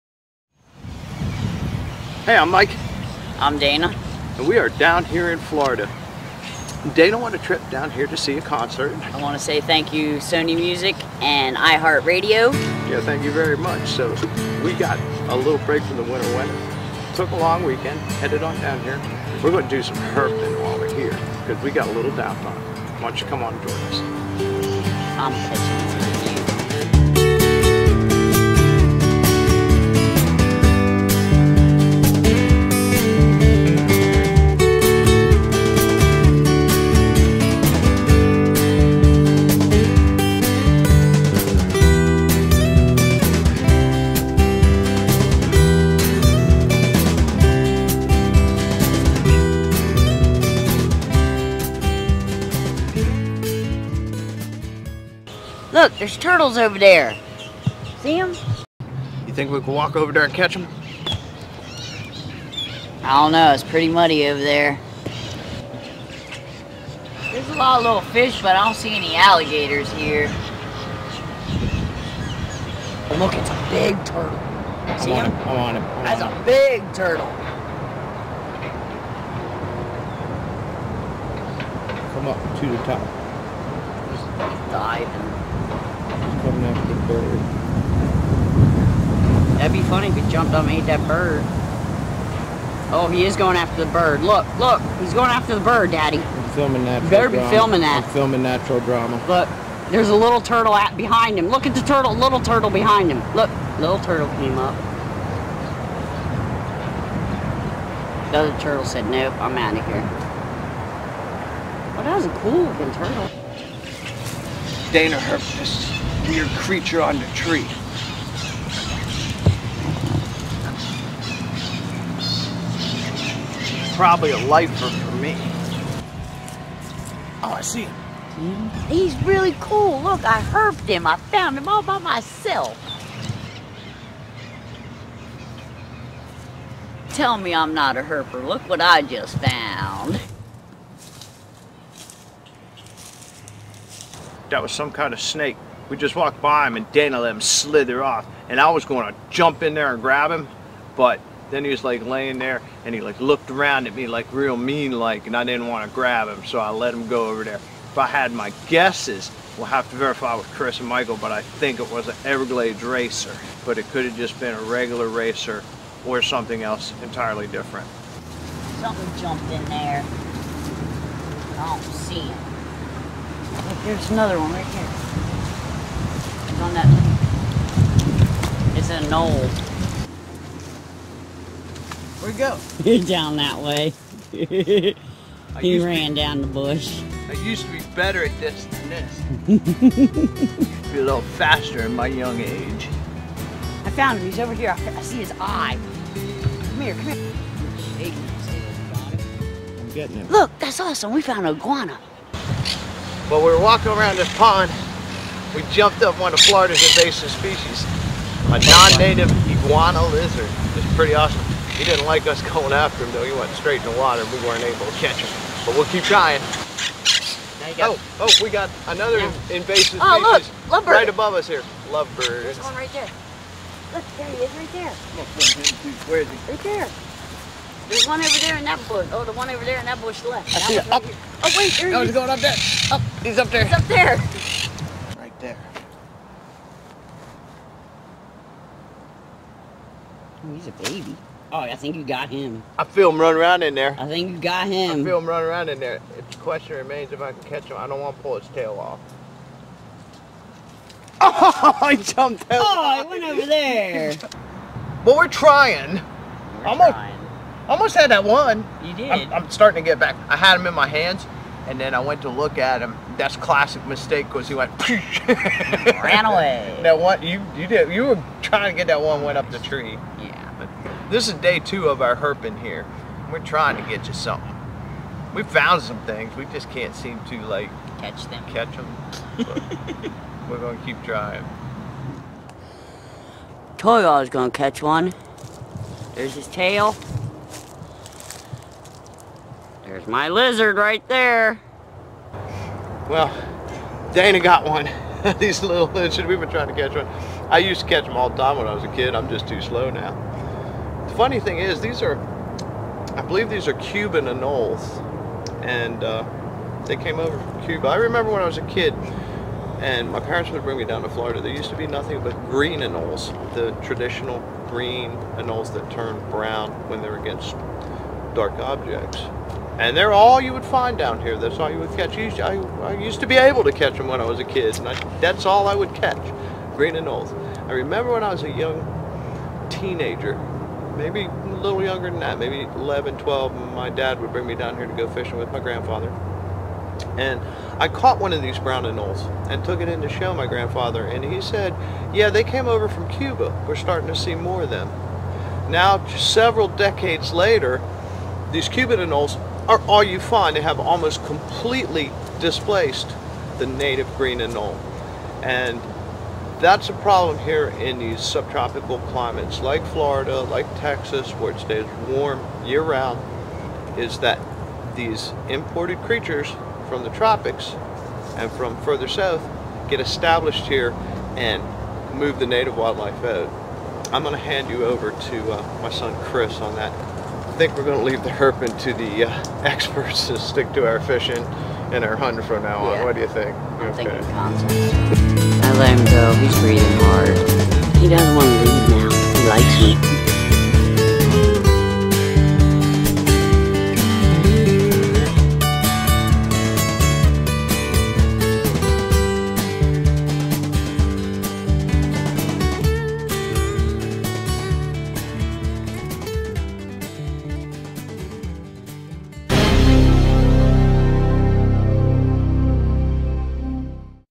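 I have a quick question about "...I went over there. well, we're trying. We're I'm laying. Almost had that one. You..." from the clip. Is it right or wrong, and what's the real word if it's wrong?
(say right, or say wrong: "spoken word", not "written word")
wrong: "trying", not "laying".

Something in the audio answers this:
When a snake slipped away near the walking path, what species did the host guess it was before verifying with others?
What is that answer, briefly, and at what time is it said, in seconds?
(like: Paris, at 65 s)
Everglades racer, at 162 s.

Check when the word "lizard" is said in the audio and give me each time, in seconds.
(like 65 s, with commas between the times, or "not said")
210 s, 290 s, 295 s.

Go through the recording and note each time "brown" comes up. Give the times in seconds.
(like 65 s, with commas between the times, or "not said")
316 s, 338 s.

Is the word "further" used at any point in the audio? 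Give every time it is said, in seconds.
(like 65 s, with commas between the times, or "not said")
368 s.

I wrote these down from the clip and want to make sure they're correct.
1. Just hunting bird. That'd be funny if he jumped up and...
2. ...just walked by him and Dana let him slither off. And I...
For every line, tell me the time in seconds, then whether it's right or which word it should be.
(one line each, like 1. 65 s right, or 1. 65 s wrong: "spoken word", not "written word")
1. 84 s wrong: "diving", not "hunting"
2. 145 s right.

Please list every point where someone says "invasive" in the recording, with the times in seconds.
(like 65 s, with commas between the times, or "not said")
206 s, 219 s.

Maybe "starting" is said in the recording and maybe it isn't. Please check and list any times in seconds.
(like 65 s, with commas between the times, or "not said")
259 s, 343 s.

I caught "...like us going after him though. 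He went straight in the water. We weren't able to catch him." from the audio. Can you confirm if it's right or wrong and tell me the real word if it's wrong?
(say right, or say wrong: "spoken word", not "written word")
right.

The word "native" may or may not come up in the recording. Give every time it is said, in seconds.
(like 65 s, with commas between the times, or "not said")
208 s, 353 s, 372 s.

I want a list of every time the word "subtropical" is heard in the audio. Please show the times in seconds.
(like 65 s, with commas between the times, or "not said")
358 s.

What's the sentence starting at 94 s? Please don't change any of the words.
Look, look, he's going after the bird, Daddy.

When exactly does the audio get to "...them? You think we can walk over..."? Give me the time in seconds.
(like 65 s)
58 s.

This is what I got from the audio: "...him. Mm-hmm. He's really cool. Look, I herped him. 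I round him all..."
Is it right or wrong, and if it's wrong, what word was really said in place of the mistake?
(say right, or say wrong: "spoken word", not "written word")
wrong: "found", not "round".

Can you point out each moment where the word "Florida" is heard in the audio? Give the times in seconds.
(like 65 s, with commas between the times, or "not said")
5 s, 206 s, 311 s, 359 s.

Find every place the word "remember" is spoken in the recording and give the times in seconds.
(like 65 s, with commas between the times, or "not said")
307 s, 327 s.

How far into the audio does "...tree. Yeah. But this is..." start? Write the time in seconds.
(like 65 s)
269 s.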